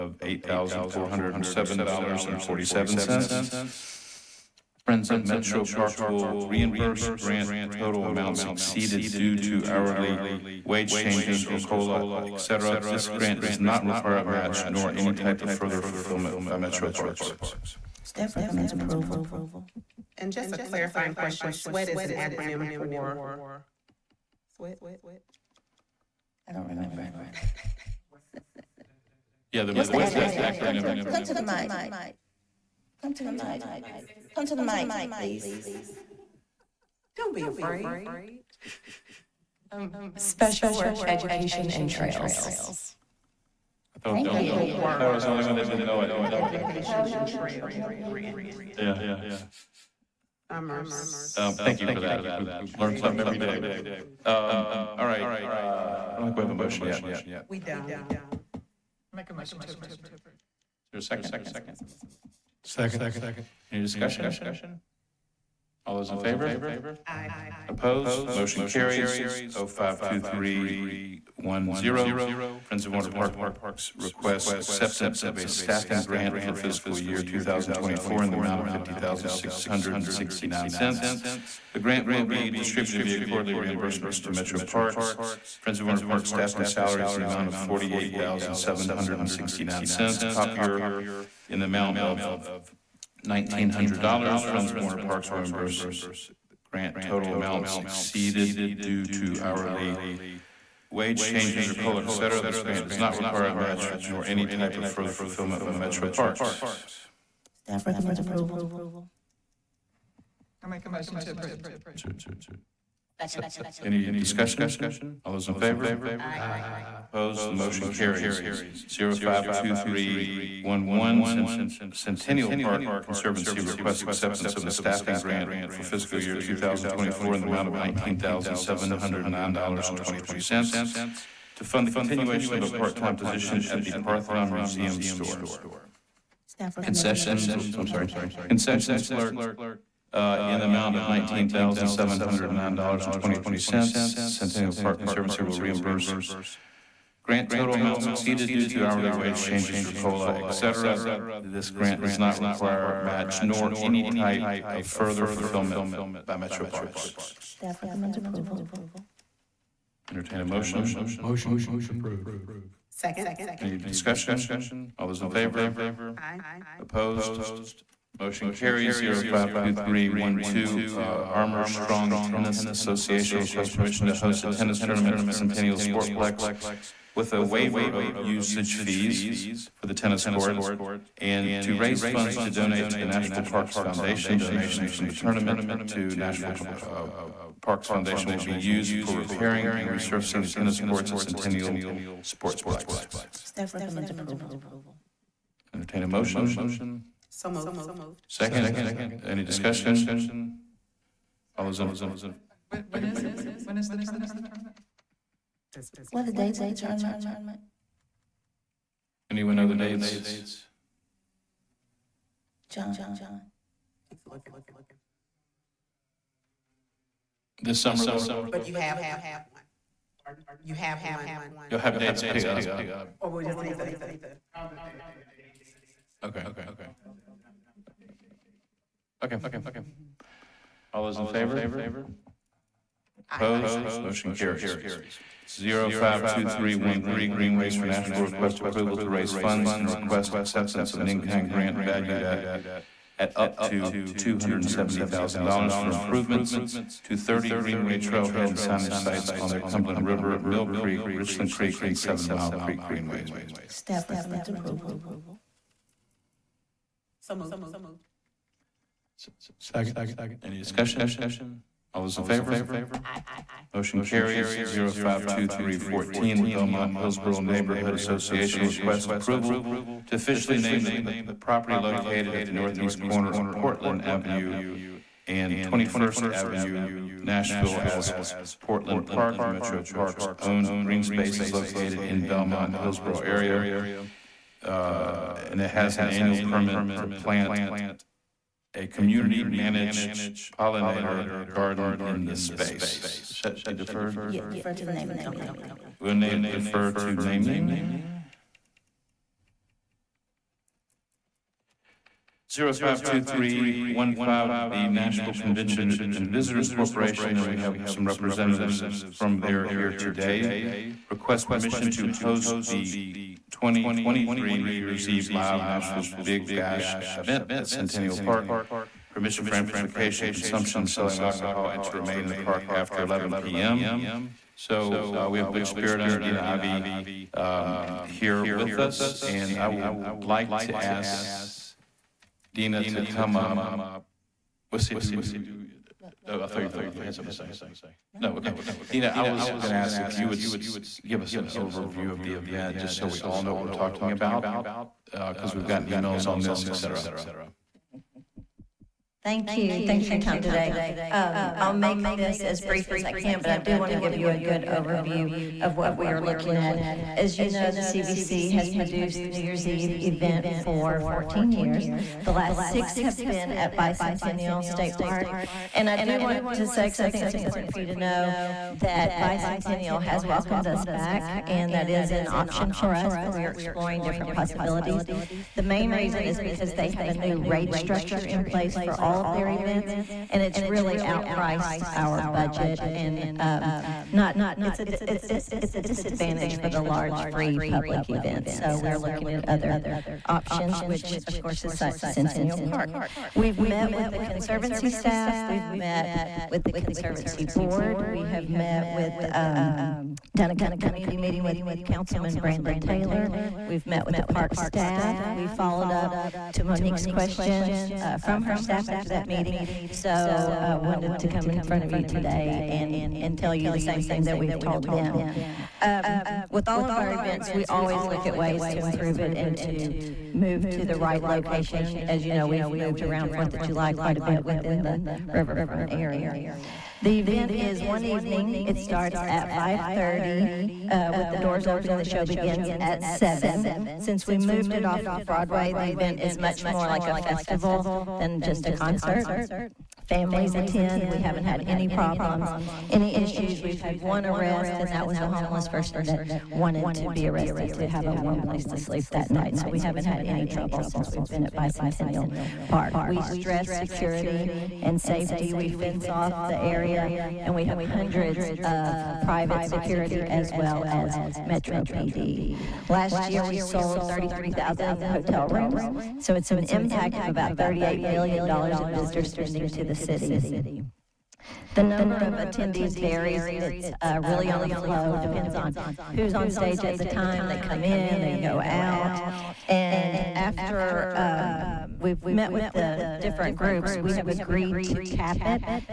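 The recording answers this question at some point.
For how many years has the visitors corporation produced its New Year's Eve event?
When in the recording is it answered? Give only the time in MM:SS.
06:01.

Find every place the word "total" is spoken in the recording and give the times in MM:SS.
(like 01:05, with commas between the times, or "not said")
00:07, 01:37, 02:27.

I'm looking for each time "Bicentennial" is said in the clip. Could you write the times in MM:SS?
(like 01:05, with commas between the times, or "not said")
06:03, 06:09, 07:31.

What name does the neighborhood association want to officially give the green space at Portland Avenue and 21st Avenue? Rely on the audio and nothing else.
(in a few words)
Portland Park.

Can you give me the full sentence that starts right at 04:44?
Uh, and it has an annual permit to plant a community managed pollinator garden in this space.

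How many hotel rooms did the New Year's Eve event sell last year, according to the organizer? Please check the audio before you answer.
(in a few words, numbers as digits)
33,000.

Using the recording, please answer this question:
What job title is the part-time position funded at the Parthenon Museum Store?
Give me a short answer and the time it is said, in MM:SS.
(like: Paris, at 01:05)
Concessions clerk, at 02:18.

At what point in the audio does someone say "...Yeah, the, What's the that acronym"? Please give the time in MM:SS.
00:29.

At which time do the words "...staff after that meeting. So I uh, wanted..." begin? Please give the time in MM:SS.
06:48.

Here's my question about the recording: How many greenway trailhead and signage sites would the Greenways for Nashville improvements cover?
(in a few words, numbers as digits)
30.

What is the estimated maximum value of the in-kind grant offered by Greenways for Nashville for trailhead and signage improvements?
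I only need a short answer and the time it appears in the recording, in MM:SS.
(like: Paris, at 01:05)
$270,000, at 04:04.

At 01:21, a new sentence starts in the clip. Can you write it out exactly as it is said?
The grant will be distributed via quarterly reimbursements to Metro Parks.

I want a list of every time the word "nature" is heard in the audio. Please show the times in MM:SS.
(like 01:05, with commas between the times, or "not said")
not said.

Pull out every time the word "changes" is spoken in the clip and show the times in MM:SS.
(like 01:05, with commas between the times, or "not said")
00:10, 01:41, 02:29.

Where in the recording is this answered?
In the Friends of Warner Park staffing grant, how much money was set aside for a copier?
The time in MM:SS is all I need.
01:33.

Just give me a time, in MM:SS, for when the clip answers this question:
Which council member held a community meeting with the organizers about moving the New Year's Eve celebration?
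06:42.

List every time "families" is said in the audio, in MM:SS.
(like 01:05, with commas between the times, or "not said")
07:20.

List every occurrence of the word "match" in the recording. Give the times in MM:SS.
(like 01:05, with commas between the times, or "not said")
00:14, 01:43, 02:32.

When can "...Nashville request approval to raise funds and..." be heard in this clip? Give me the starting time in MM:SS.
03:57.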